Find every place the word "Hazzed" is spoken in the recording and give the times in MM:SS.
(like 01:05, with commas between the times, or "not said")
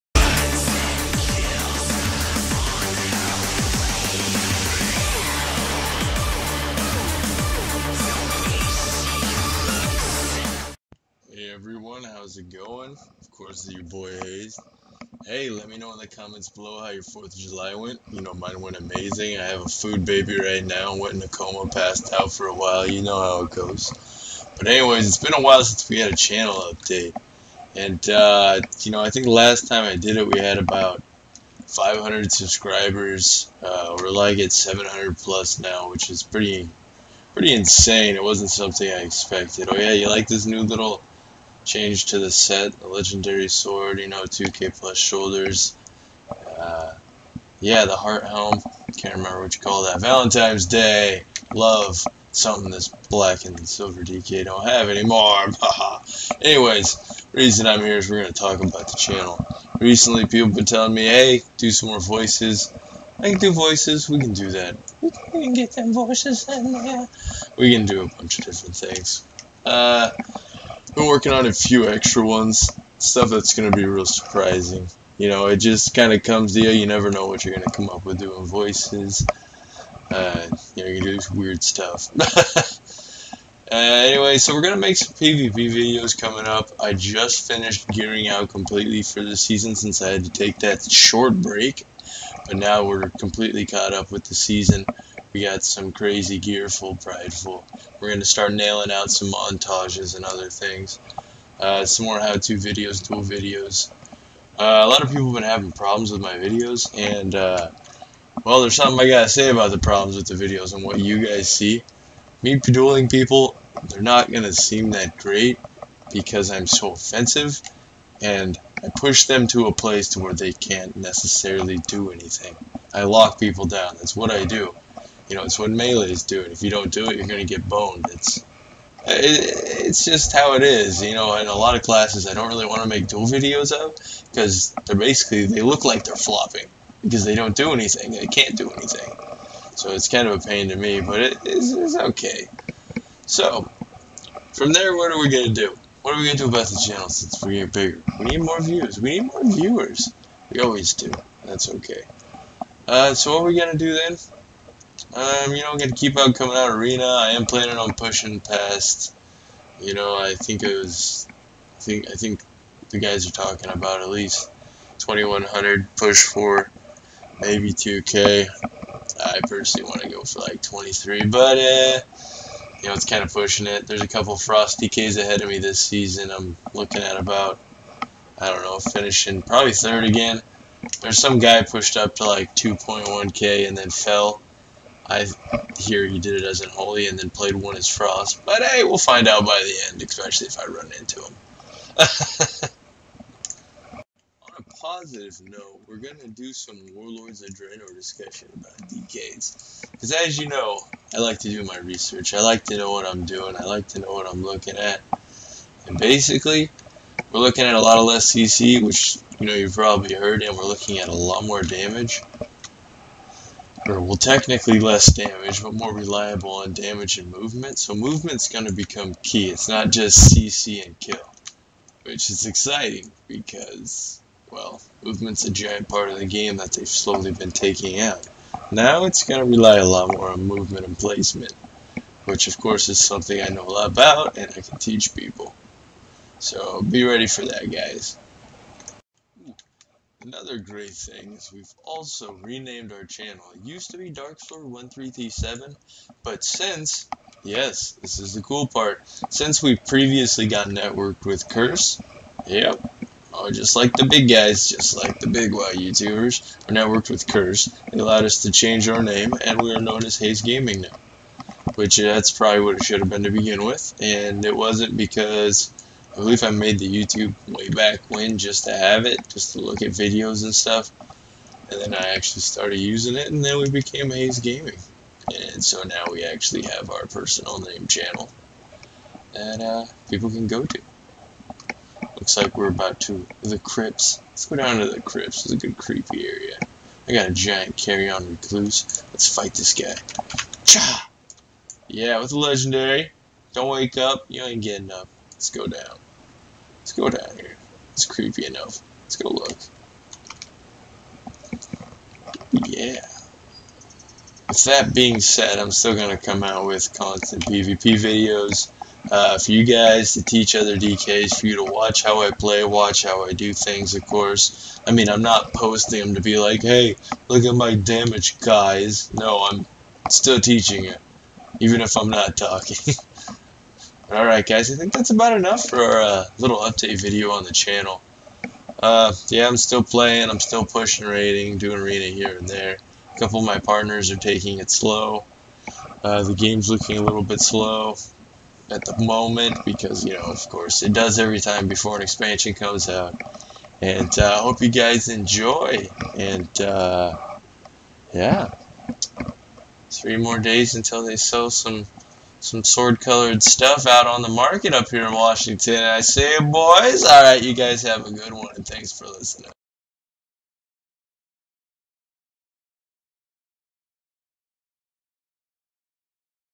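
04:20, 04:34.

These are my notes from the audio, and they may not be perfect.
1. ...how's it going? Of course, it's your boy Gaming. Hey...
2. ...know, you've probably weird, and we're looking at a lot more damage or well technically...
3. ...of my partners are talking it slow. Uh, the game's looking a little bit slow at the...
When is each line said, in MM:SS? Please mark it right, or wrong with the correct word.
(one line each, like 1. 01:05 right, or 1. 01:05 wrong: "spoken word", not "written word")
1. 00:12 wrong: "Hayes", not "Gaming"
2. 03:29 wrong: "heard", not "weird"
3. 05:33 wrong: "taking", not "talking".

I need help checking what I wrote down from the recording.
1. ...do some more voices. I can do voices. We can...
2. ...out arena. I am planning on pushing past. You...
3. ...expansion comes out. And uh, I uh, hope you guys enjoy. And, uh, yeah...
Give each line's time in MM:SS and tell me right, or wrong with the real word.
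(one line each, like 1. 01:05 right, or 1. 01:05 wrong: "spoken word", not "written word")
1. 01:01 right
2. 02:36 right
3. 05:42 right.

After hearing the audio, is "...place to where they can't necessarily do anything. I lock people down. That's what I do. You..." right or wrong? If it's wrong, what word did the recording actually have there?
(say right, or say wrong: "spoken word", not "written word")
right.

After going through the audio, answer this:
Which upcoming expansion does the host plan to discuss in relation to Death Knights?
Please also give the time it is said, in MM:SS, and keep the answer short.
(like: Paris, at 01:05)
Warlords of Draenor, at 03:16.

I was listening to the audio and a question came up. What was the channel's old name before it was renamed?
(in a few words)
Dark 1337.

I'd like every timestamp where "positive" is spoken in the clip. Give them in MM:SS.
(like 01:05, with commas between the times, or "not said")
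03:14.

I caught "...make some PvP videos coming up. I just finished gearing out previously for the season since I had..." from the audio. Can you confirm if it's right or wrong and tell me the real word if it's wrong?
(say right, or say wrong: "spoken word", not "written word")
wrong: "completely", not "previously".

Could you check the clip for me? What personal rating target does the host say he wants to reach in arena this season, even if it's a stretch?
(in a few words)
23.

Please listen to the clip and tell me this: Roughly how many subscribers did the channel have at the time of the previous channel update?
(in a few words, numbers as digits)
500.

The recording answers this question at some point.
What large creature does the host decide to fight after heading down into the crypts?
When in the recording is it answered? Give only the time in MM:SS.
04:47.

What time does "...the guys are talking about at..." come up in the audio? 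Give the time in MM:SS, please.
02:42.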